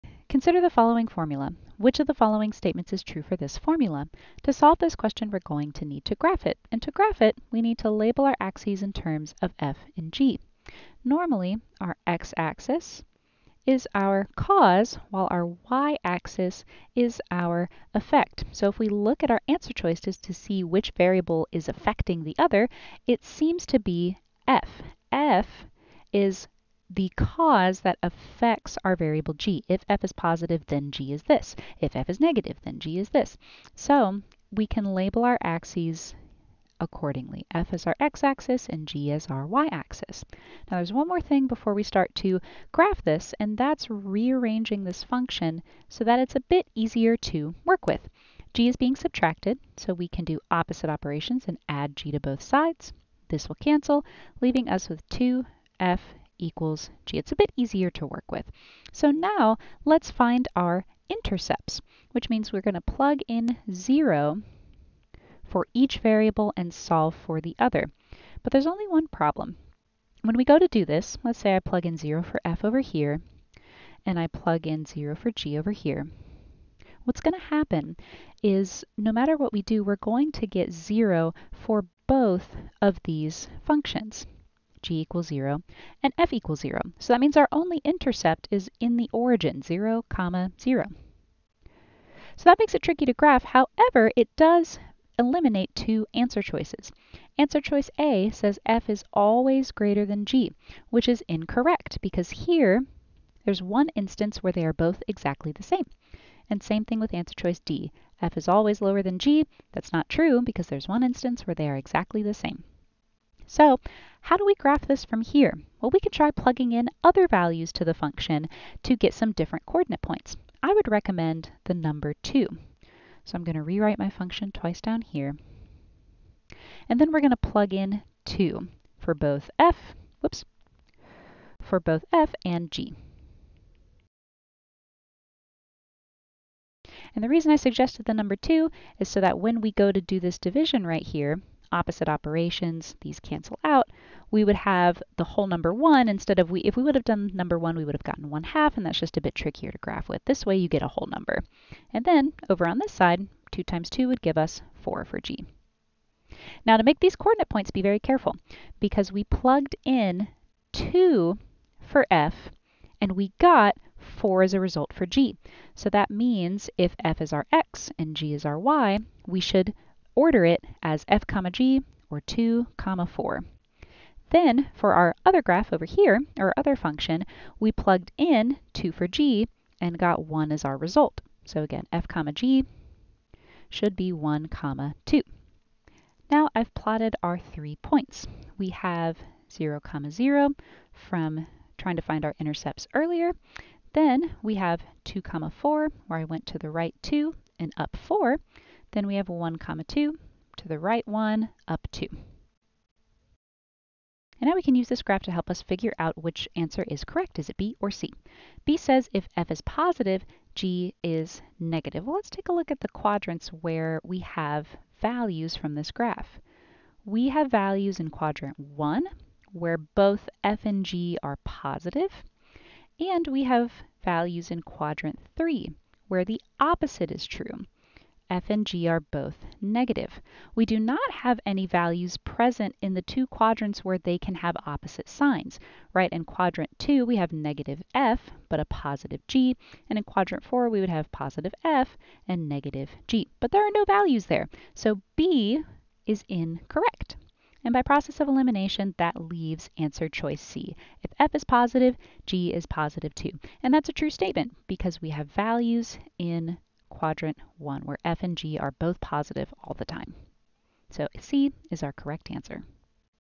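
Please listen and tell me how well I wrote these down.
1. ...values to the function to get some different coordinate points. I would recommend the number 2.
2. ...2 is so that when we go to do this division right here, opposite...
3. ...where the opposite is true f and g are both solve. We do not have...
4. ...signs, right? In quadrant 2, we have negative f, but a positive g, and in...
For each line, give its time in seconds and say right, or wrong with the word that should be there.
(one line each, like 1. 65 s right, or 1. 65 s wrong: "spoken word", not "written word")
1. 117 s right
2. 138 s right
3. 226 s wrong: "negative", not "solve"
4. 235 s right.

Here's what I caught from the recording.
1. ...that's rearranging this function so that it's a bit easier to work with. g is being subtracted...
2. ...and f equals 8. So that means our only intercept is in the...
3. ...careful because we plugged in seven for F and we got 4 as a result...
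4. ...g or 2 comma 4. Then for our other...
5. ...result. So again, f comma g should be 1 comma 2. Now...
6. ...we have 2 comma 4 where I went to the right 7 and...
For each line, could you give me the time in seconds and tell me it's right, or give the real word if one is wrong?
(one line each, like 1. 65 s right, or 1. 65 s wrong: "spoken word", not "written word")
1. 43 s right
2. 86 s wrong: "0", not "8"
3. 157 s wrong: "two", not "seven"
4. 171 s right
5. 180 s right
6. 194 s wrong: "2", not "7".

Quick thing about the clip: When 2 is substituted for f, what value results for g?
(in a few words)
4.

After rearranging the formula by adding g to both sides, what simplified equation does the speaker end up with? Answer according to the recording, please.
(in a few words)
2f = g.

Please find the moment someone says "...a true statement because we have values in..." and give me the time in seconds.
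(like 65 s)
253 s.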